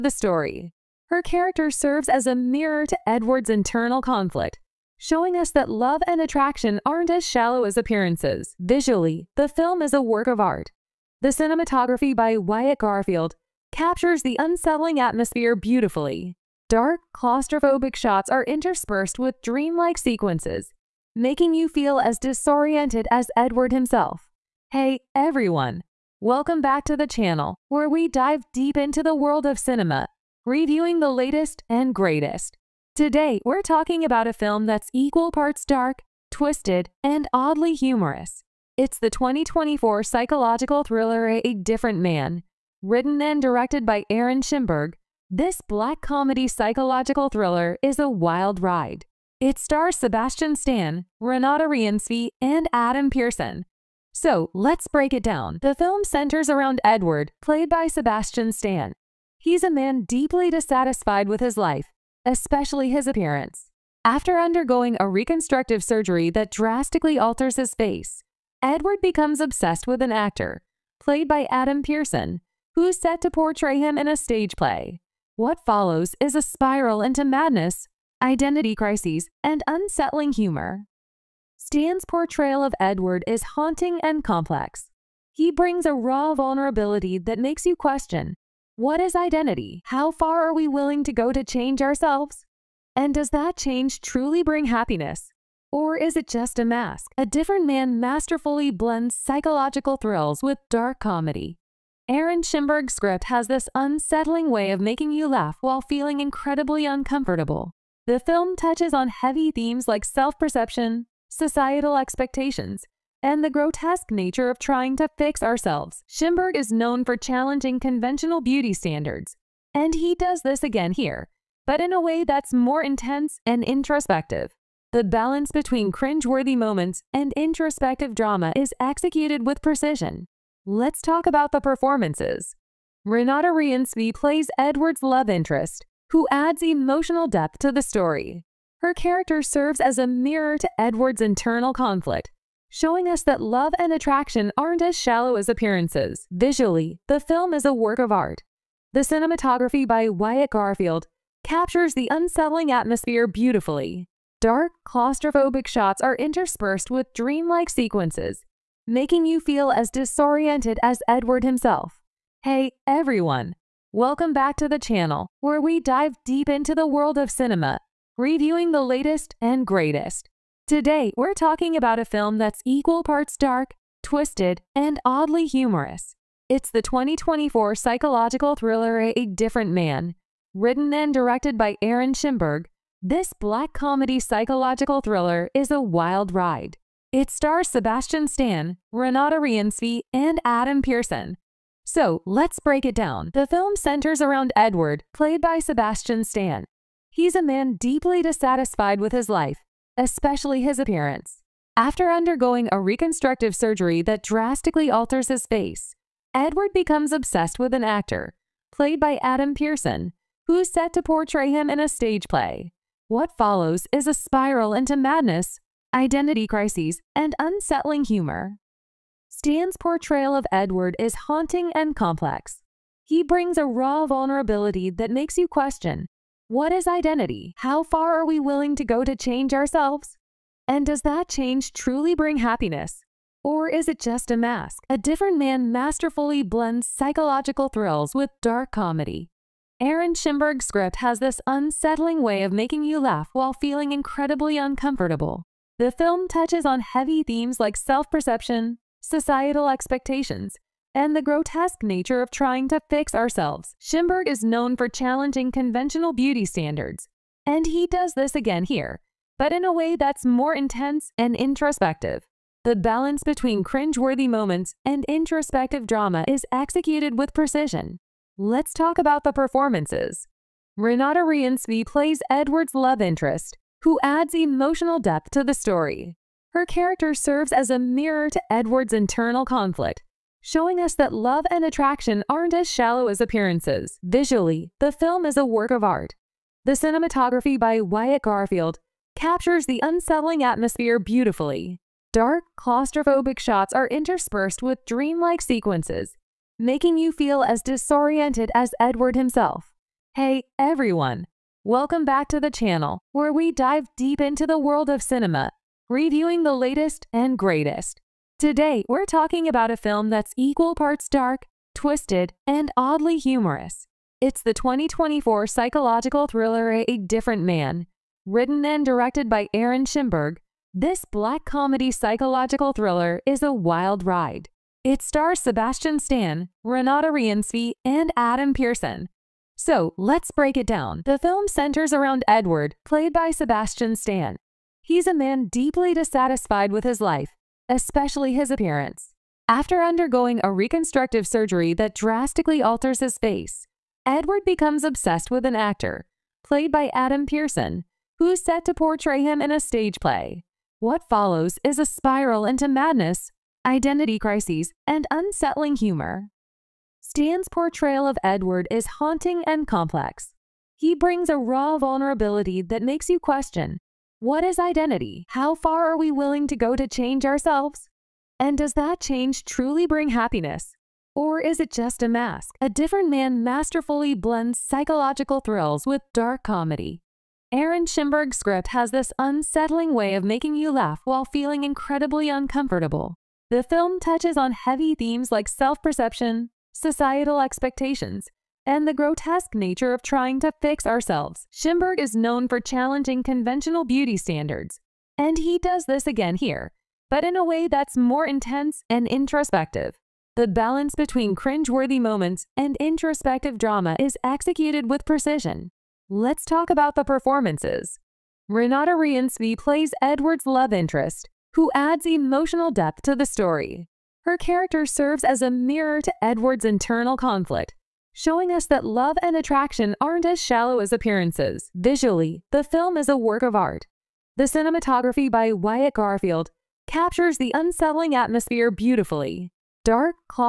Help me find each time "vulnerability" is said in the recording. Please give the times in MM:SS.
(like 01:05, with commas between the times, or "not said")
01:26, 03:44, 06:01.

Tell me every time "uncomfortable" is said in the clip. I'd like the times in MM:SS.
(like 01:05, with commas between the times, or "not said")
01:46, 04:04, 06:22.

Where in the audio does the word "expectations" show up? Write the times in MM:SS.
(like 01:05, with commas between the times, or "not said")
01:51, 04:09, 06:27.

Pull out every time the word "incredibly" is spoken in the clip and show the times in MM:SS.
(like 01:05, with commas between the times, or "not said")
01:46, 04:03, 06:21.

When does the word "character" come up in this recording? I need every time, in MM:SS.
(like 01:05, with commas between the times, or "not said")
00:01, 02:18, 04:36, 06:54.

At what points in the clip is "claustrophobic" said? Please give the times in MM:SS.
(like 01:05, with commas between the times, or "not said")
00:17, 02:34, 04:52.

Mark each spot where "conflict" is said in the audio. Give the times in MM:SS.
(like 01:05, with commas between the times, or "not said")
00:04, 02:21, 04:39, 06:57.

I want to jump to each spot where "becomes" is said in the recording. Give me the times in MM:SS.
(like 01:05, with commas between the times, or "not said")
01:09, 03:26, 05:44.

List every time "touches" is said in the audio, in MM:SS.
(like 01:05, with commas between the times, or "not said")
01:48, 04:06, 06:23.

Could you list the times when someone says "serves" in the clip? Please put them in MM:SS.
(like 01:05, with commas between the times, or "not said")
00:01, 02:19, 04:37, 06:54.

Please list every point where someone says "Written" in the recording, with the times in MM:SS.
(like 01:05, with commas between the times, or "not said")
00:42, 03:00, 05:18.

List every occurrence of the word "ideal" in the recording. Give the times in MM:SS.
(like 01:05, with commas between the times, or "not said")
not said.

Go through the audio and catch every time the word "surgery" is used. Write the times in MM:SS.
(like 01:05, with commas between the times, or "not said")
01:05, 03:23, 05:41.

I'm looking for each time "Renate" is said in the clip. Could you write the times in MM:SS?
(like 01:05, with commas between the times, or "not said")
00:51, 02:13, 03:08, 04:30, 05:26, 06:48.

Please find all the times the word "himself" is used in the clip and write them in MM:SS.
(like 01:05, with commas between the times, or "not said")
00:23, 02:41, 04:59.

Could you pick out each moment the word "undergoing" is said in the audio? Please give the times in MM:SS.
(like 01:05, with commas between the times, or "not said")
01:04, 03:22, 05:39.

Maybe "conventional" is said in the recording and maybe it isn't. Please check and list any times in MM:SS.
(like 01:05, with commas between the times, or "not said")
01:57, 04:15, 06:33.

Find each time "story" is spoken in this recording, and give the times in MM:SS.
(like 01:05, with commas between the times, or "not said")
00:00, 02:17, 04:35, 06:53.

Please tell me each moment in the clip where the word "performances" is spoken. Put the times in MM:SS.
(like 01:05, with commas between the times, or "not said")
02:11, 04:29, 06:47.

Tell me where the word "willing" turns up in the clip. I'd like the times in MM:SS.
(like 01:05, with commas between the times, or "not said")
01:30, 03:48, 06:06.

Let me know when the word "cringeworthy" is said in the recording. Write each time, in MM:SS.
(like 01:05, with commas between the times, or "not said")
02:05, 04:23, 06:41.